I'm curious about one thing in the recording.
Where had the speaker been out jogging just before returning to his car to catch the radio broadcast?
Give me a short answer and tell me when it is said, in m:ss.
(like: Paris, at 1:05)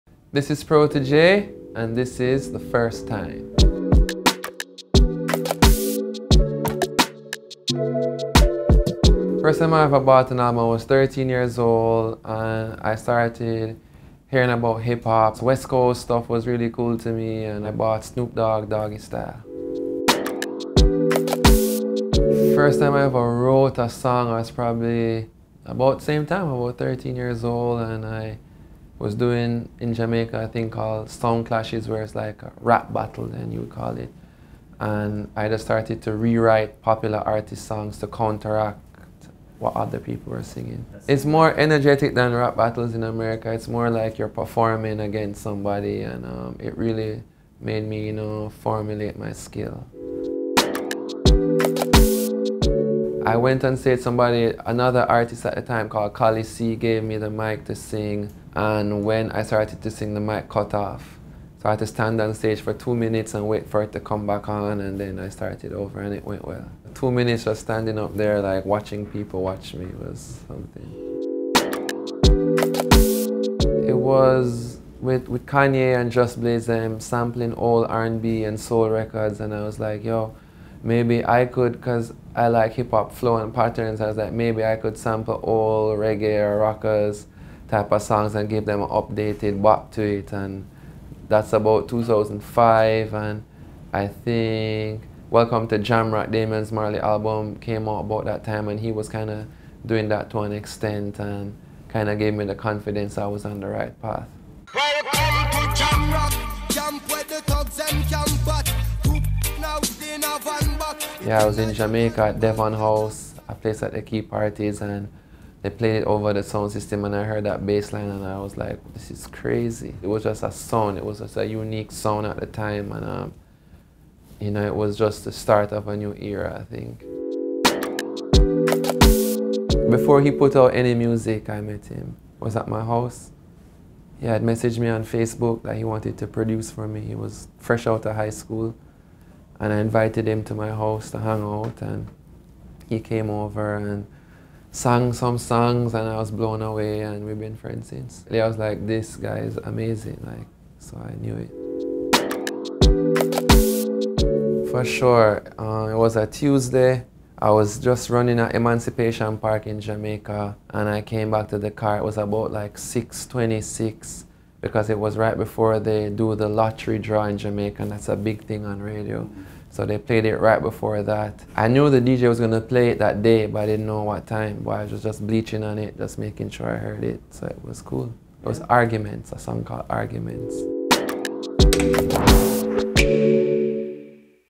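Emancipation Park, at 2:38.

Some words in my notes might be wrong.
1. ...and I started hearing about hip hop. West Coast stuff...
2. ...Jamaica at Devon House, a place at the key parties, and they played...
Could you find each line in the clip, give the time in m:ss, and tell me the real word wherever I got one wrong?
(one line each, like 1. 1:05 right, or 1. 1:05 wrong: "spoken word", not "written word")
1. 0:12 right
2. 1:51 right.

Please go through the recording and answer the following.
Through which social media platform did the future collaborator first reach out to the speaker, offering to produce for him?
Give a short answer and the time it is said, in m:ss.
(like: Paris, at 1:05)
Facebook, at 2:15.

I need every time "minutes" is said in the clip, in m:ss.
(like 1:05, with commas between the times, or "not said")
1:02, 1:07.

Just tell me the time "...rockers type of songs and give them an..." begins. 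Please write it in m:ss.
1:26.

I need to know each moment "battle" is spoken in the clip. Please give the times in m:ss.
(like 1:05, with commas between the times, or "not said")
0:32, 0:42.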